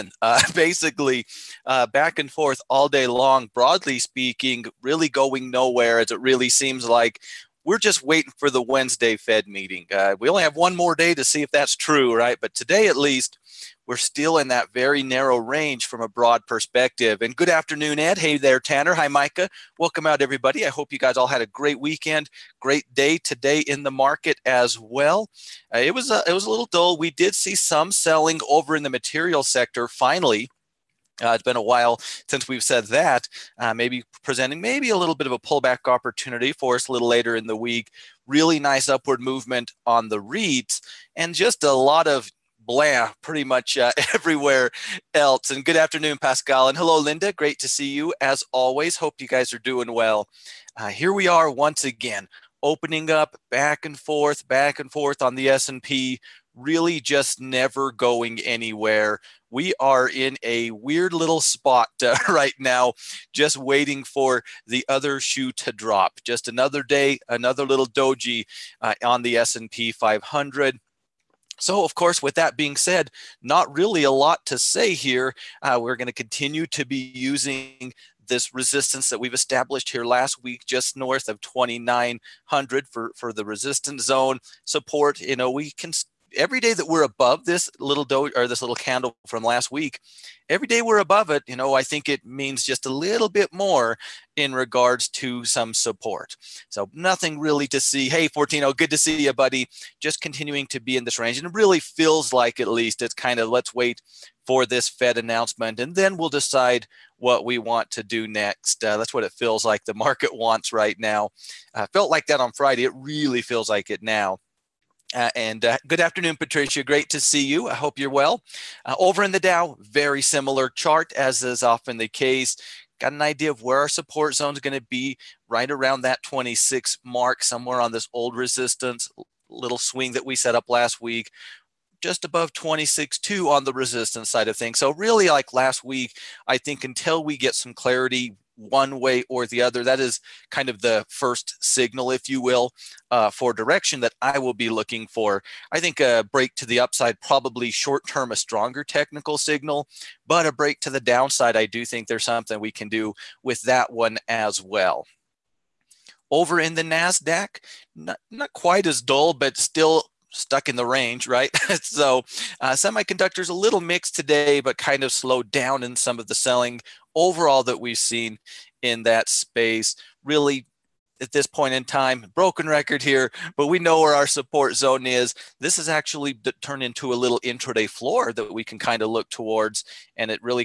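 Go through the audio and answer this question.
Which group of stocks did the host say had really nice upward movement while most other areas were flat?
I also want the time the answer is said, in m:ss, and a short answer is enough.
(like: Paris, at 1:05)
REITs, at 0:40.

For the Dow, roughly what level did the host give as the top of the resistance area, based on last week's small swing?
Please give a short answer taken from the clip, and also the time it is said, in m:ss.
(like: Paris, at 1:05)
26.2, at 2:12.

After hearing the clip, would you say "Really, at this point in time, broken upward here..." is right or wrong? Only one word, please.
wrong.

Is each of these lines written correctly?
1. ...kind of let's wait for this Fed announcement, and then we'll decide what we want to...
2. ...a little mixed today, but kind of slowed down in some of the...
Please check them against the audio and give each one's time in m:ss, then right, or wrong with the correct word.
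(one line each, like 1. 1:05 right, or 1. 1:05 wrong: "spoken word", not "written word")
1. 1:43 right
2. 2:43 right.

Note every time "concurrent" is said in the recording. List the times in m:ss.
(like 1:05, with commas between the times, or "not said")
not said.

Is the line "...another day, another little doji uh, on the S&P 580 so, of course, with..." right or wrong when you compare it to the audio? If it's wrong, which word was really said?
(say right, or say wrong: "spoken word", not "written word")
wrong: "500", not "580".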